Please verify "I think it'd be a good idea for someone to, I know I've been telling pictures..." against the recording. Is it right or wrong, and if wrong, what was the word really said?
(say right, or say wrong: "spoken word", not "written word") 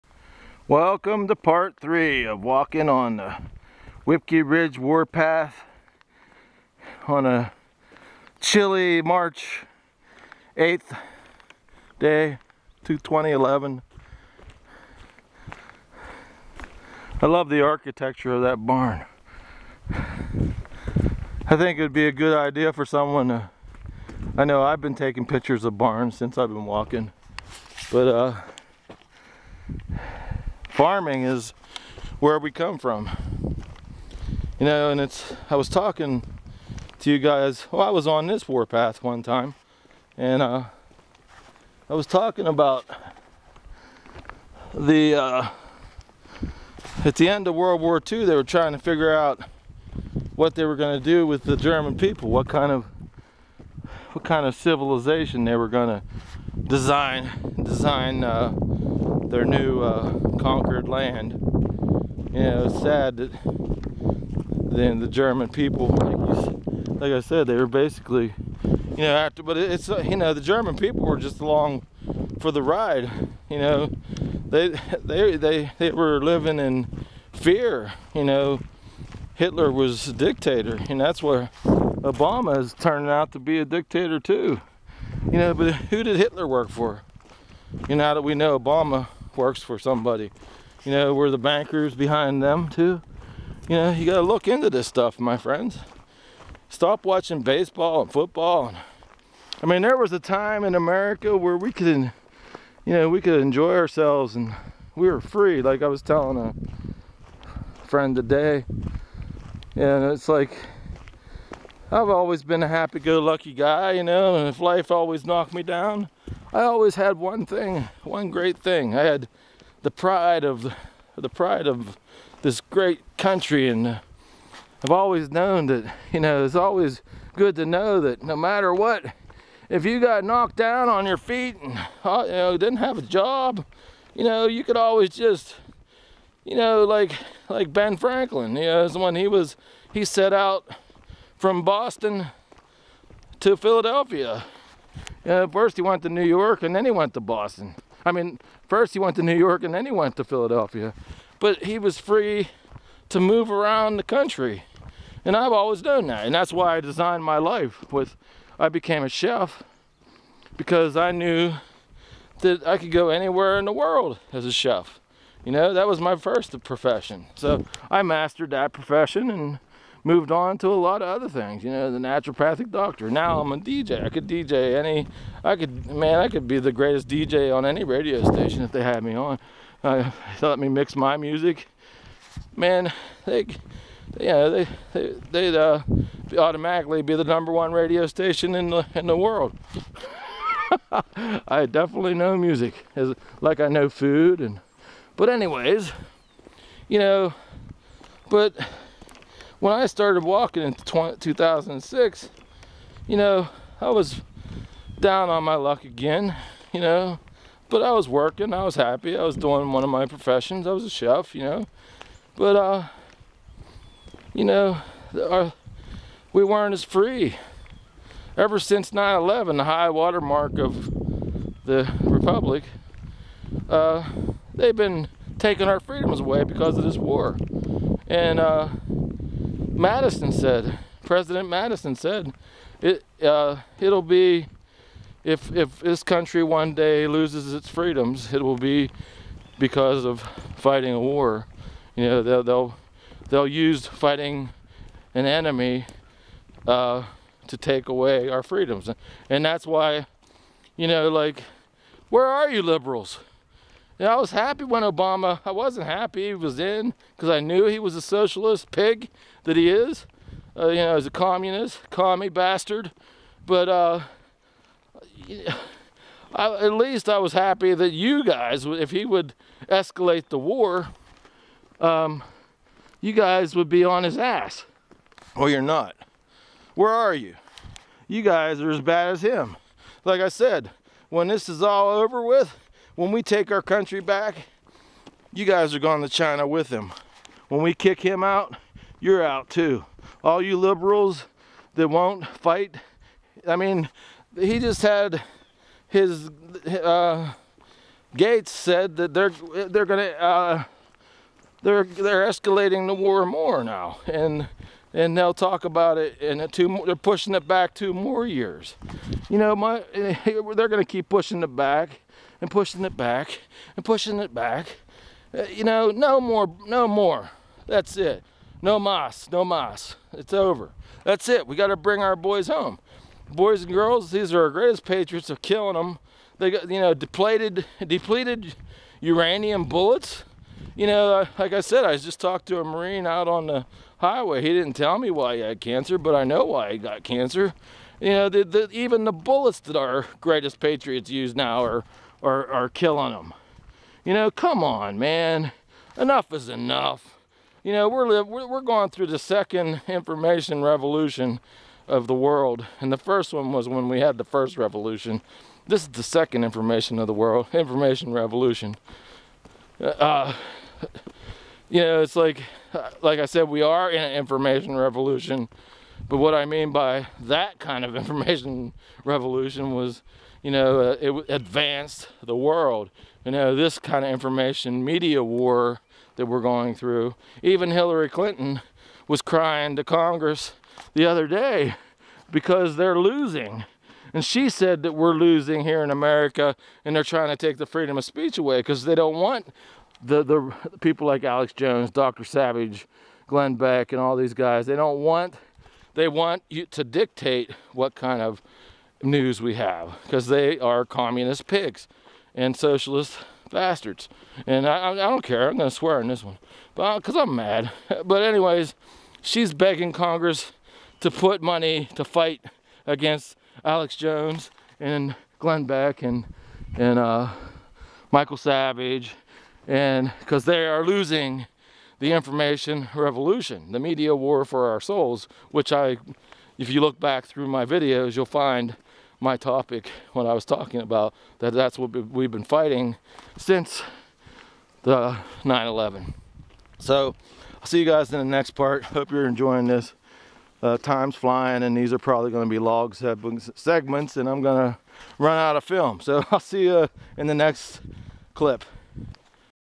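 wrong: "taking", not "telling".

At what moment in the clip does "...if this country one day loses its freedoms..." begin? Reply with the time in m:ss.
3:55.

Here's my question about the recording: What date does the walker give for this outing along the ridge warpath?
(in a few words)
March 8th.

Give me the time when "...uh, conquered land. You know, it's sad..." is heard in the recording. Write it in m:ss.
0:59.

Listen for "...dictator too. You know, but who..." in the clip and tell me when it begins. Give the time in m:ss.
1:23.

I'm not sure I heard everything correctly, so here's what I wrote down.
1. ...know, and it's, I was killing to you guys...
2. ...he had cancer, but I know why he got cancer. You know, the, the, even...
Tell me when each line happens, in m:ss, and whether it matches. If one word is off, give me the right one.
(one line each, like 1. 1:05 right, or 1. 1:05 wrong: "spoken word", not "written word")
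1. 0:34 wrong: "talking", not "killing"
2. 5:35 right.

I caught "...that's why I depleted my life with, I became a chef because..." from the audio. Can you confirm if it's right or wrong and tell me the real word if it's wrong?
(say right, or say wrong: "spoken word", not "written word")
wrong: "designed", not "depleted".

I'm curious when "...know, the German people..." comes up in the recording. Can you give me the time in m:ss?
1:10.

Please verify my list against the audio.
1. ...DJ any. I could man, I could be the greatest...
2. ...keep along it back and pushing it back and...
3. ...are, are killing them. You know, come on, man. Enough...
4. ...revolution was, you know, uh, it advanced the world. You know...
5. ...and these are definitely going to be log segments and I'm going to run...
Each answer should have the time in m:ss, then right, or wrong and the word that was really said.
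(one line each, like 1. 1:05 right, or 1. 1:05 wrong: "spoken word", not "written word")
1. 2:54 right
2. 5:10 wrong: "pushing", not "along"
3. 5:42 right
4. 6:09 right
5. 7:21 wrong: "probably", not "definitely".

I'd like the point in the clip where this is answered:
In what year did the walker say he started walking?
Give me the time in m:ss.
3:20.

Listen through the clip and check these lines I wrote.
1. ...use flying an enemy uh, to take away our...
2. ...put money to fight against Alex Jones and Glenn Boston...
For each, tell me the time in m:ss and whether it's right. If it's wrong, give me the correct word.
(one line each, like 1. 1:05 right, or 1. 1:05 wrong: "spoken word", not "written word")
1. 4:03 wrong: "fighting", not "flying"
2. 6:51 wrong: "Beck", not "Boston".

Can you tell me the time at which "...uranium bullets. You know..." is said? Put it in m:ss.
5:28.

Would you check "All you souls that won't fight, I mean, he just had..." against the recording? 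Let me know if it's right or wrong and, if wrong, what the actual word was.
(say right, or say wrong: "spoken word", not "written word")
wrong: "liberals", not "souls".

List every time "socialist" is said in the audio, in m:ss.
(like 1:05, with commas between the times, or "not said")
4:18, 6:42.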